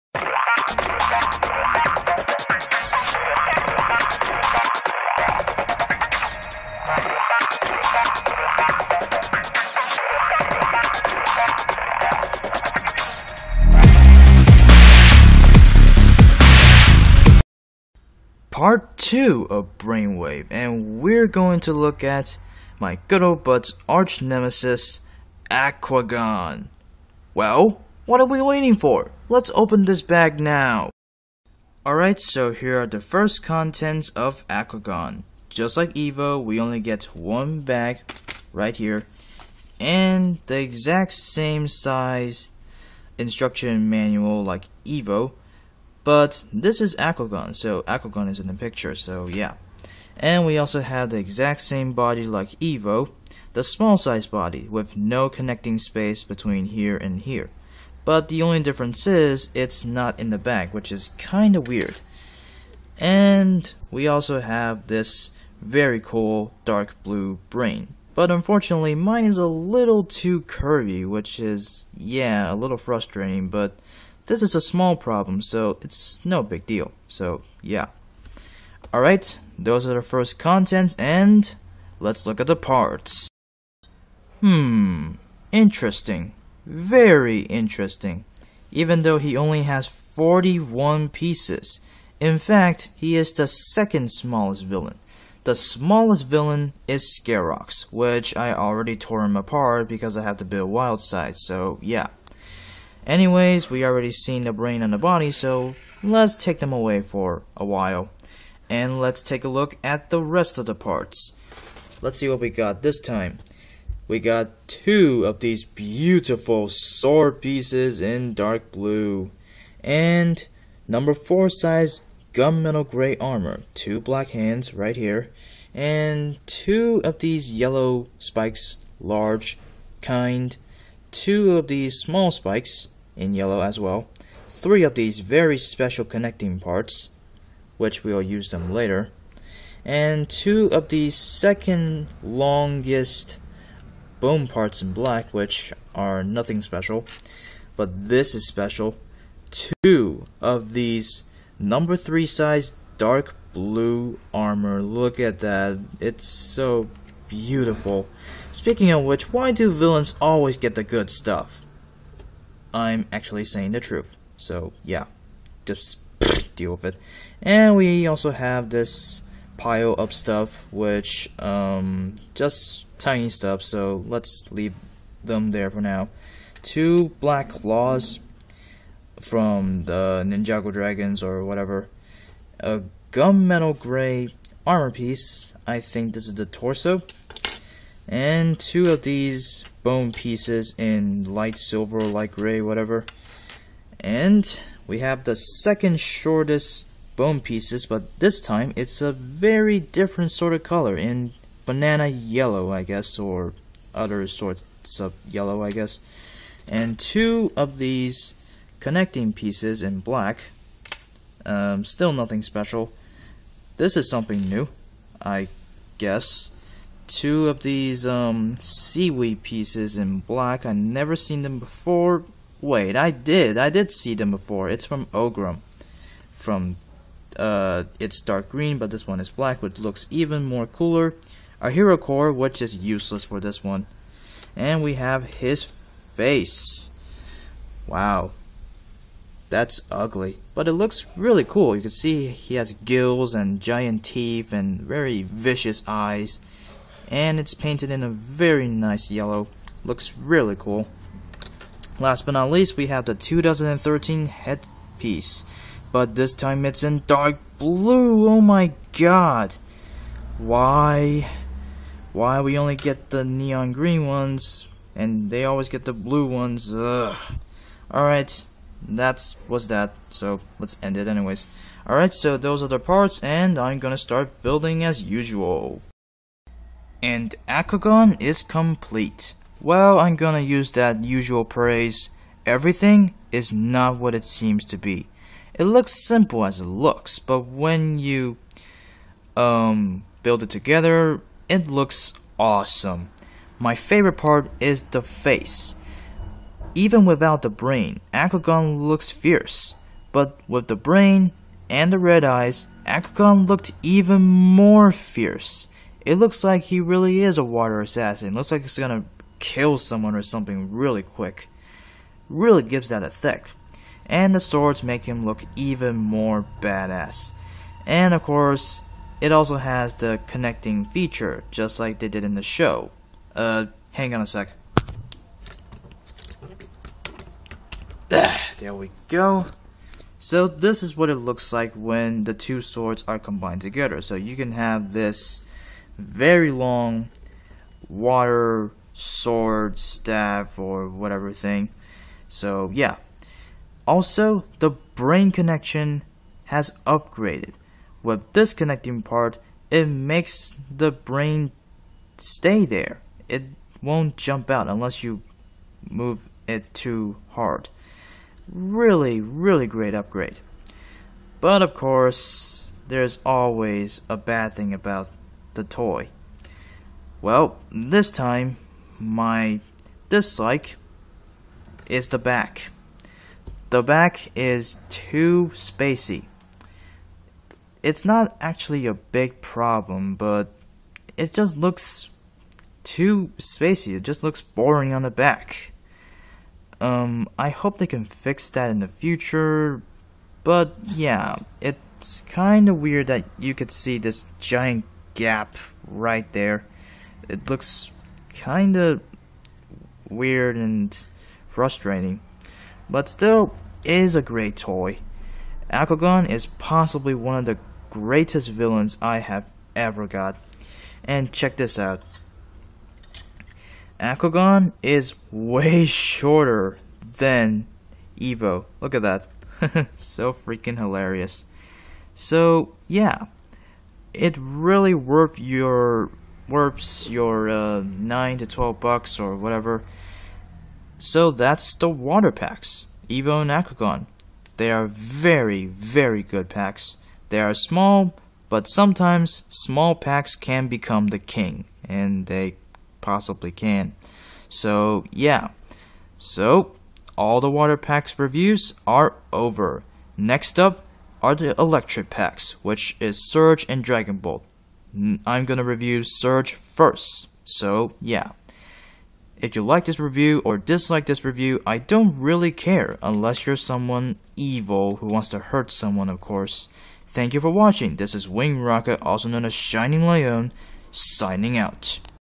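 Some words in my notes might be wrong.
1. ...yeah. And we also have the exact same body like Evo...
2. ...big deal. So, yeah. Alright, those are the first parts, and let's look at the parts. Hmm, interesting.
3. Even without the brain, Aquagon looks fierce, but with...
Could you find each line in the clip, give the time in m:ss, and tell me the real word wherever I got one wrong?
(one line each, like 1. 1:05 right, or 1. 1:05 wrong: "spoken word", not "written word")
1. 0:49 right
2. 1:16 wrong: "contents", not "parts"
3. 4:56 right.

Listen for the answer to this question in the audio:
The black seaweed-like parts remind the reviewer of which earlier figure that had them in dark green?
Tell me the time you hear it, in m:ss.
3:45.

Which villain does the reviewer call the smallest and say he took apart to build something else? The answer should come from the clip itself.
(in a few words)
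Scarox.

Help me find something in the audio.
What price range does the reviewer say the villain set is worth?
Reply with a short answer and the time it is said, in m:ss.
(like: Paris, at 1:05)
9 to 12 bucks, at 7:07.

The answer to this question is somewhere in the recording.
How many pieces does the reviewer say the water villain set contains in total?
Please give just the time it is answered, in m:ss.
1:29.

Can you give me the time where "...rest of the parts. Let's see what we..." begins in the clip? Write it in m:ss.
1:50.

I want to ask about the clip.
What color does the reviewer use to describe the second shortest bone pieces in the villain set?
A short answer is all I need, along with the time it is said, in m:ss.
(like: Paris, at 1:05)
banana yellow, at 3:21.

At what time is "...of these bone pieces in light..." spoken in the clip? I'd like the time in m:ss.
3:08.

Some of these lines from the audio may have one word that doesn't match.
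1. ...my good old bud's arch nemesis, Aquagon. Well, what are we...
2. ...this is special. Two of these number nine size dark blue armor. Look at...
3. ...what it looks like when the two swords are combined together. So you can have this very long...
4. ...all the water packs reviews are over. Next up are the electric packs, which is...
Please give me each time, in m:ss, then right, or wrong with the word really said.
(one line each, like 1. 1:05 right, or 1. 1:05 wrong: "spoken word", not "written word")
1. 0:22 right
2. 2:28 wrong: "three", not "nine"
3. 5:30 right
4. 7:27 right.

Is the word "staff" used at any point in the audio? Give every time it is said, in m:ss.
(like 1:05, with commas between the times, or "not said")
5:39.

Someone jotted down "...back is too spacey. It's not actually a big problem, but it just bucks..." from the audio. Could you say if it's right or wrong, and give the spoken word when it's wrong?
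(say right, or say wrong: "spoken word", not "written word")
wrong: "looks", not "bucks".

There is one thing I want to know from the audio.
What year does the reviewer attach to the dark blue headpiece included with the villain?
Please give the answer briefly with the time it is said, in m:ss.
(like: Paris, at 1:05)
2013, at 4:13.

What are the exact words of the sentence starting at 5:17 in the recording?
And of course, it also has the connecting feature, just like they did in the show.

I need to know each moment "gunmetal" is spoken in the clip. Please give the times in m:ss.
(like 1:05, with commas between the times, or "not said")
2:02, 3:03.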